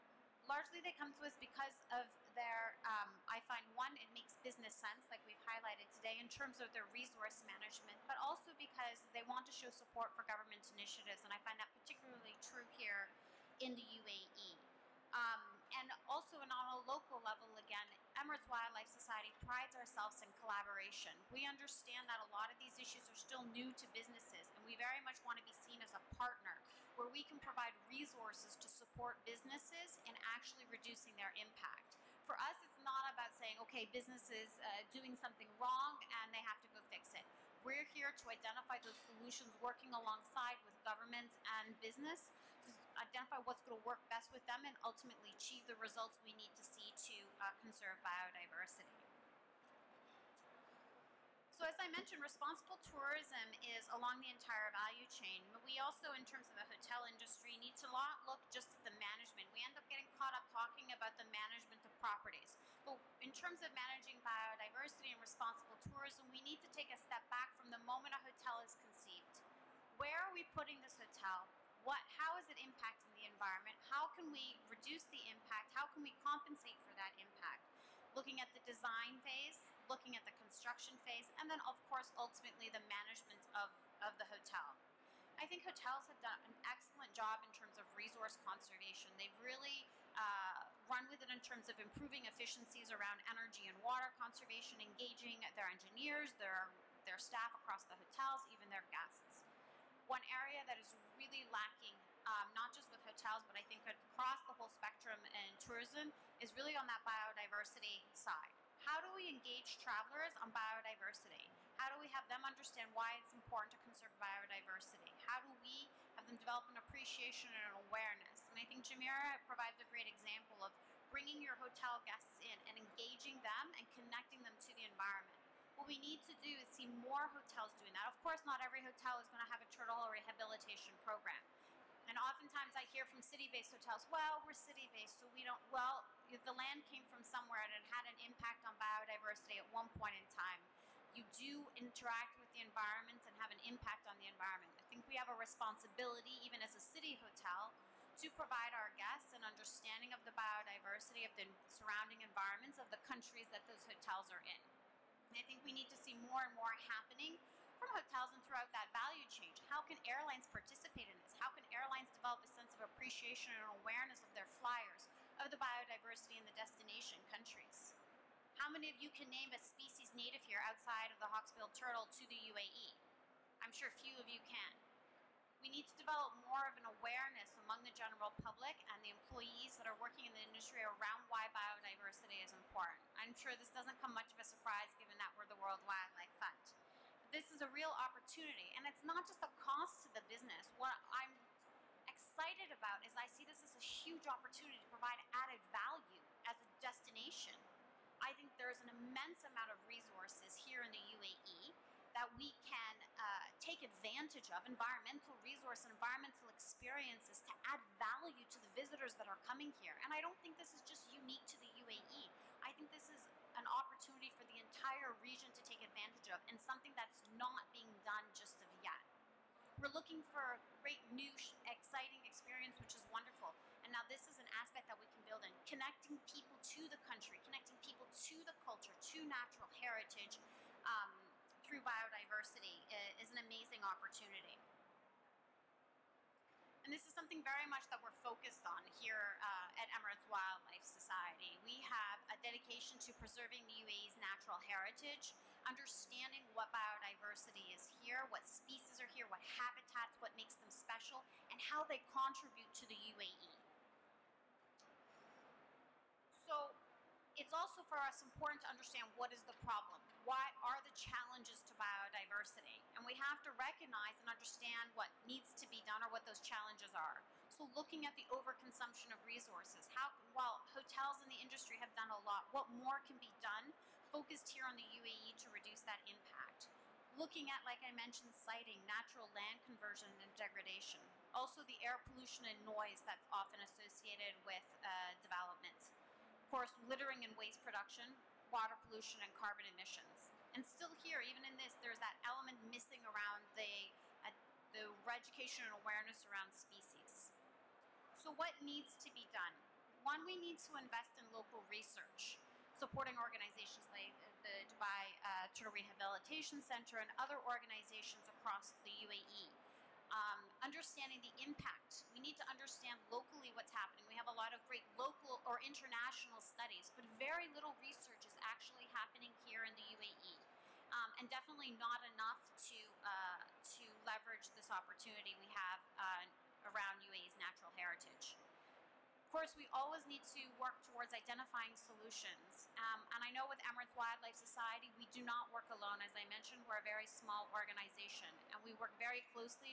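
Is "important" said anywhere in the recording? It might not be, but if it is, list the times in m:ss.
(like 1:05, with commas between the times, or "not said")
1:53, 3:02, 4:18.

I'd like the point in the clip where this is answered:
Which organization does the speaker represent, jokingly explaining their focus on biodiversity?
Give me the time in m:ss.
3:05.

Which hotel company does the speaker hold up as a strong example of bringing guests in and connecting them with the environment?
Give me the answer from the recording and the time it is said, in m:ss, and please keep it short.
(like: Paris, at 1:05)
Jumeirah, at 1:58.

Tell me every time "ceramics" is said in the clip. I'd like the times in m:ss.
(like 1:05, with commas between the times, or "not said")
not said.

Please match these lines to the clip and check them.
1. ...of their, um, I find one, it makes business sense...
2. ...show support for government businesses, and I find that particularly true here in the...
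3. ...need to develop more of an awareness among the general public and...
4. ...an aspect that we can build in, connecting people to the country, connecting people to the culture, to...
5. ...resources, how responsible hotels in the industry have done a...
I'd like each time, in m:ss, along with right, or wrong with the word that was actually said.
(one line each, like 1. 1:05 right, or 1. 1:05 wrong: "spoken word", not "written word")
1. 0:01 right
2. 0:09 wrong: "initiatives", not "businesses"
3. 2:55 right
4. 3:44 right
5. 4:29 wrong: "while", not "responsible".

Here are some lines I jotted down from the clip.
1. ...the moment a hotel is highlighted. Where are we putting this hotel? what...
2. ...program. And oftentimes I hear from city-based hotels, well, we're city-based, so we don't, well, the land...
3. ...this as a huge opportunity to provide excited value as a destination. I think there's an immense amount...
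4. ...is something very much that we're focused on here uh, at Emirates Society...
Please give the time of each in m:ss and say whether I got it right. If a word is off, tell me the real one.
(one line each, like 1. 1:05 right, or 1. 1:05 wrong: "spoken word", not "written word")
1. 1:07 wrong: "conceived", not "highlighted"
2. 2:11 right
3. 3:13 wrong: "added", not "excited"
4. 3:57 wrong: "Wildlife", not "Society".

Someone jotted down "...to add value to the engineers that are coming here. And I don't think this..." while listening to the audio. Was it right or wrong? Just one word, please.
wrong.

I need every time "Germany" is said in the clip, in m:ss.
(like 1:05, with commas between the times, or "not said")
not said.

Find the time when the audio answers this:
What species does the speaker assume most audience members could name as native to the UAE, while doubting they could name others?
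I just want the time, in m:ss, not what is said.
2:51.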